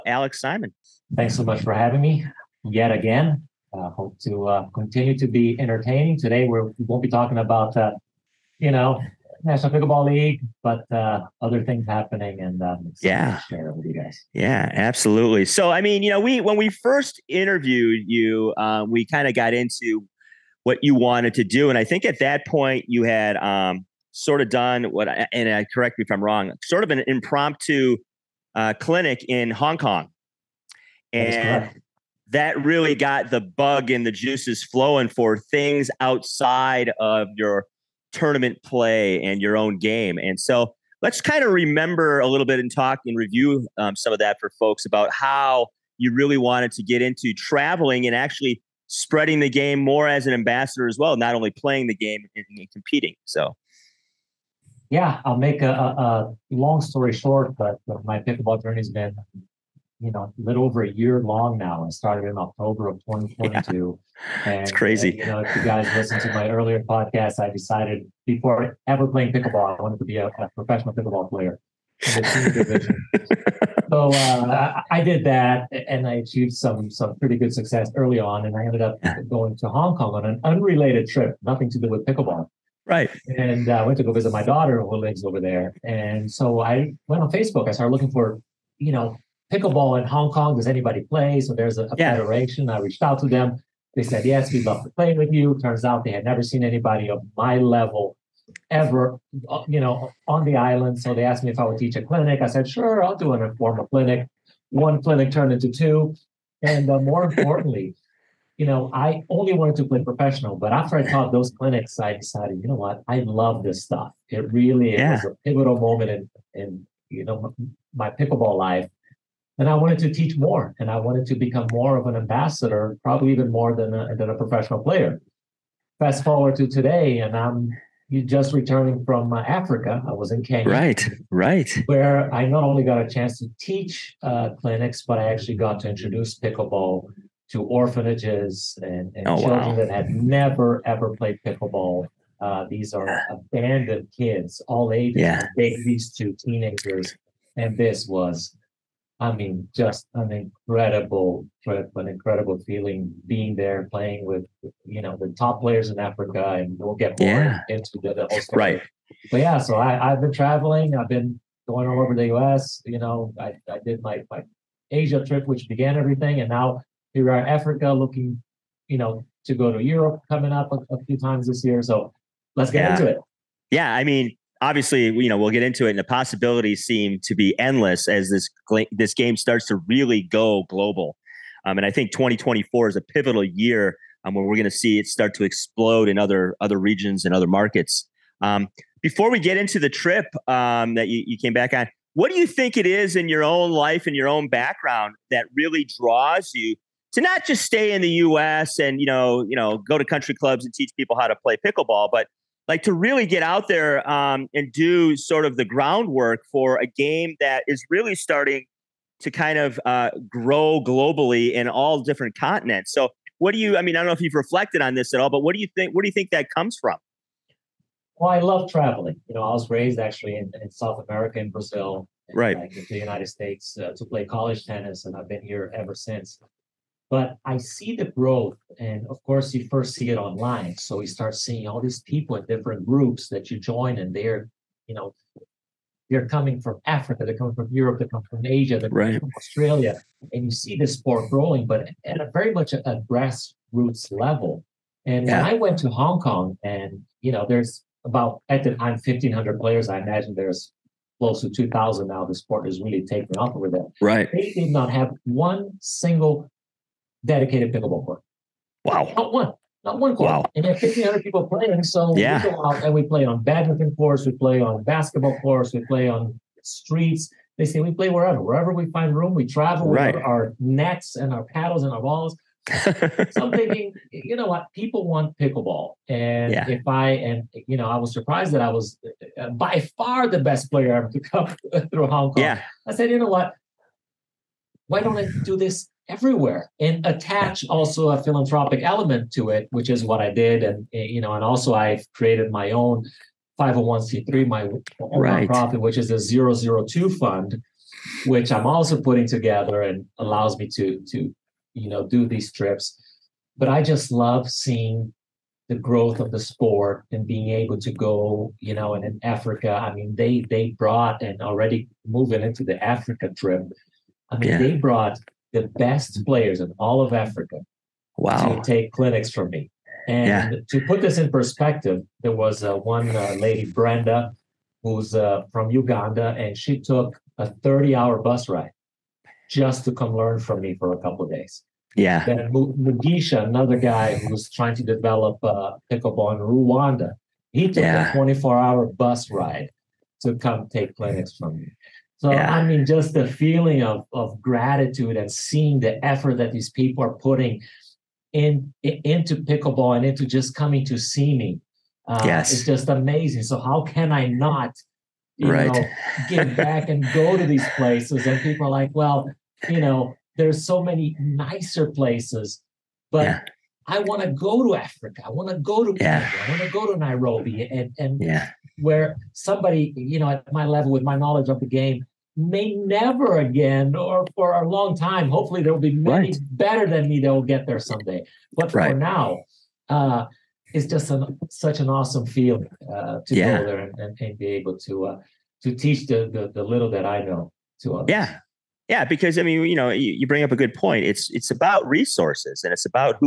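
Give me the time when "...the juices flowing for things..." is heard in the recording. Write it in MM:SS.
00:34.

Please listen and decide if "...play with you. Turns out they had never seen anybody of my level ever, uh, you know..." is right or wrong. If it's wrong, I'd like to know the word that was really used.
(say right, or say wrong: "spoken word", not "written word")
right.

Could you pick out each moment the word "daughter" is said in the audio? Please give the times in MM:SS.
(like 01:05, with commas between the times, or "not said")
01:24.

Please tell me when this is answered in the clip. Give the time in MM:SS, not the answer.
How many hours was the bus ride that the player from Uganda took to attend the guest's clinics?
05:27.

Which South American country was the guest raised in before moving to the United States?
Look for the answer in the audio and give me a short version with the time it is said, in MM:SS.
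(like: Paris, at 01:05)
Brazil, at 03:41.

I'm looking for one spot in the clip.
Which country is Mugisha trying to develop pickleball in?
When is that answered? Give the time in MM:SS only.
05:36.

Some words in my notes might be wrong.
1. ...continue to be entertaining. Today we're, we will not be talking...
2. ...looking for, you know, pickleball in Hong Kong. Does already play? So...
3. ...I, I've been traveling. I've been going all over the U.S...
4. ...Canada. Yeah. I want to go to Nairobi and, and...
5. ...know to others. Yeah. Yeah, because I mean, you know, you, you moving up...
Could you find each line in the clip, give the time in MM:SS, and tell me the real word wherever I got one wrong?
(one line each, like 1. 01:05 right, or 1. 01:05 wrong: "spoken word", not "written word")
1. 00:04 right
2. 01:27 wrong: "anybody", not "already"
3. 02:39 right
4. 06:05 right
5. 06:27 wrong: "bring", not "moving".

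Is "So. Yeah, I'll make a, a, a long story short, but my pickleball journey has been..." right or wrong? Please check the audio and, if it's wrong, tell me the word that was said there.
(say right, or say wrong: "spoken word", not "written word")
right.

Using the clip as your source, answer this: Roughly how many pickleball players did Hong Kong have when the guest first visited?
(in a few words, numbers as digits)
1,500.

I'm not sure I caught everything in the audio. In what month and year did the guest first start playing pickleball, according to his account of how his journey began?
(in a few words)
October 2022.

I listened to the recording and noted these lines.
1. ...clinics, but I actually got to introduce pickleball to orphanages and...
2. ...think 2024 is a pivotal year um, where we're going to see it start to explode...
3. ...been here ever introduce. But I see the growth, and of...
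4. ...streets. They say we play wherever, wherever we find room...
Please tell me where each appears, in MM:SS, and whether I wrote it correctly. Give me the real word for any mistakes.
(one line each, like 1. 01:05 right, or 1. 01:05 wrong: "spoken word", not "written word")
1. 02:14 right
2. 03:01 right
3. 03:45 wrong: "since", not "introduce"
4. 04:26 right.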